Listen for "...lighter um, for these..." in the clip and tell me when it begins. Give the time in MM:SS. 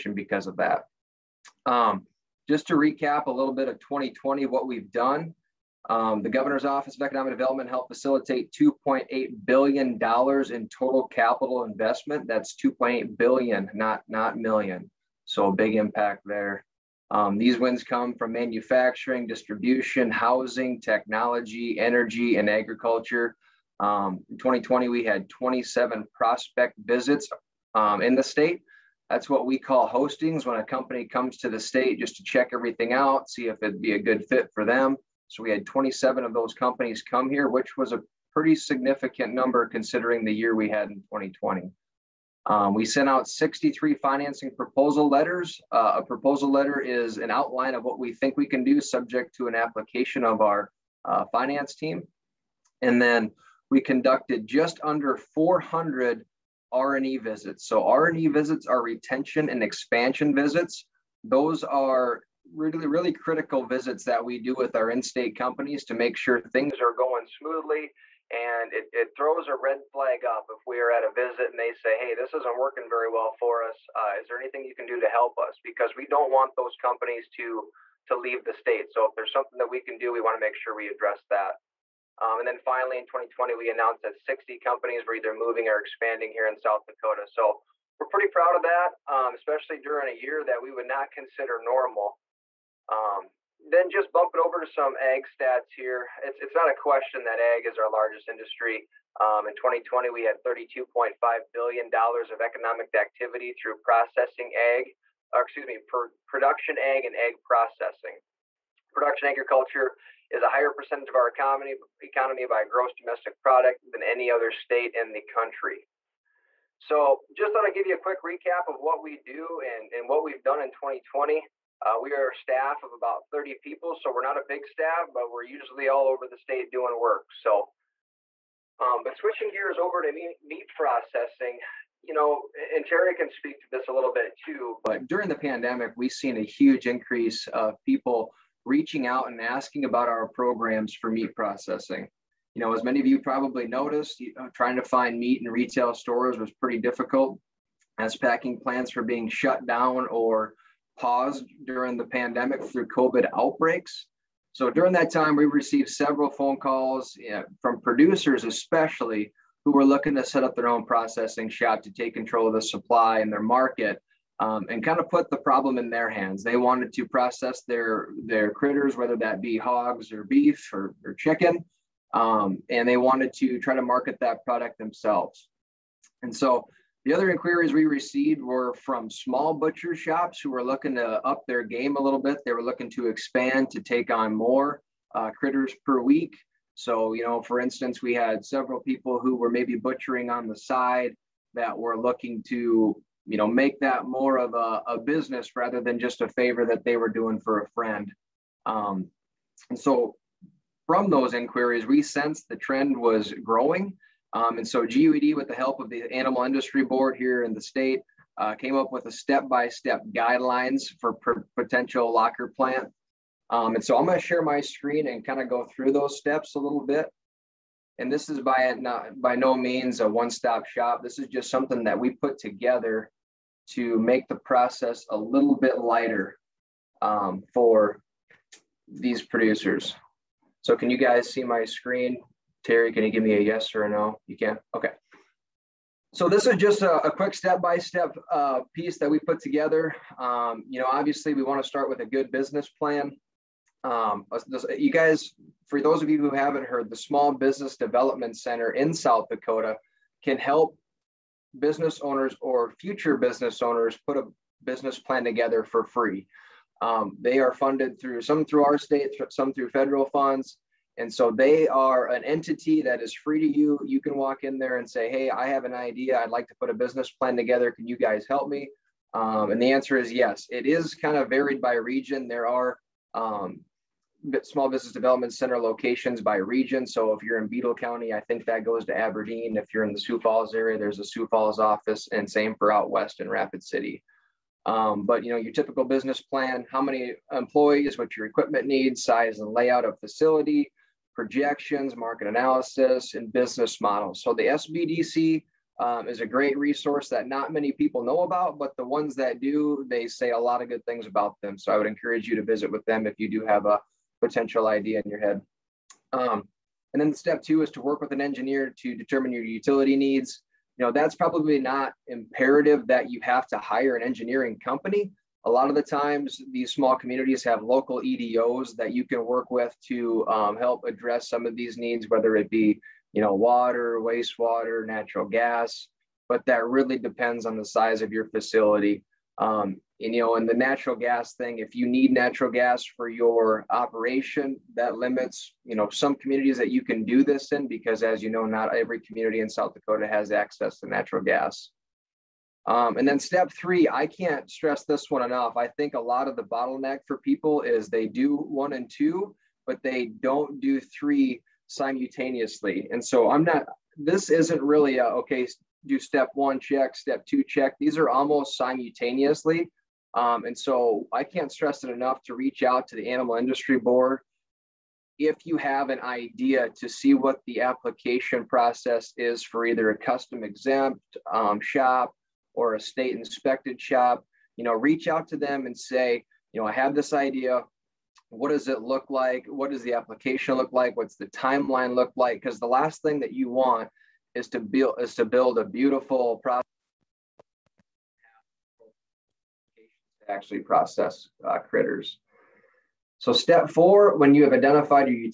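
03:45.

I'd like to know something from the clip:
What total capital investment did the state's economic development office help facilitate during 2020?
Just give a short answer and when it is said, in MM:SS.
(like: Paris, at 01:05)
2.8 billion dollars, at 00:08.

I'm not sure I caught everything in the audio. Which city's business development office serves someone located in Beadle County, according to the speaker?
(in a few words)
Aberdeen.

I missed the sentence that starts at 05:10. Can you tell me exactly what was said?
You know, that's probably not imperative that you have to hire an engineering company.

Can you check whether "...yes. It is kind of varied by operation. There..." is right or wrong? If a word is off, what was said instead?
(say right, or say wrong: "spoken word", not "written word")
wrong: "region", not "operation".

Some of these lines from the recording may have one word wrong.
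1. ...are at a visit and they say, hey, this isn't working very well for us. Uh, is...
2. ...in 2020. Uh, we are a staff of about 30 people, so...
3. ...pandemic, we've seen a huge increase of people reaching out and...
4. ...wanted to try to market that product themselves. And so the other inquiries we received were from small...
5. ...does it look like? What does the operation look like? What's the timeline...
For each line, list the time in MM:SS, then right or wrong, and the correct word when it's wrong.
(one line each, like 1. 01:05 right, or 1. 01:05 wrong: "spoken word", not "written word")
1. 01:10 right
2. 02:00 right
3. 02:15 right
4. 02:52 right
5. 06:18 wrong: "application", not "operation".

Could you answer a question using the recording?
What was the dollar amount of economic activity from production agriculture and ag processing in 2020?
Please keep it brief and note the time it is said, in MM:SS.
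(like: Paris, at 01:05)
$32.5 billion, at 01:40.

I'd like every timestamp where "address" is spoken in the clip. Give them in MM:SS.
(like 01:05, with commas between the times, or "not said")
01:20, 05:20.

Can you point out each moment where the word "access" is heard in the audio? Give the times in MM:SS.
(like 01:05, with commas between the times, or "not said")
05:40.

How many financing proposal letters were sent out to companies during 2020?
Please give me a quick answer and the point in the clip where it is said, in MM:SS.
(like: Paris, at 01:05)
63, at 00:43.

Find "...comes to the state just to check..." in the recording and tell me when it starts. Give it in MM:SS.
00:31.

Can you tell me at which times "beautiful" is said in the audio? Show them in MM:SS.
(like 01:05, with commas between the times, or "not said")
06:25.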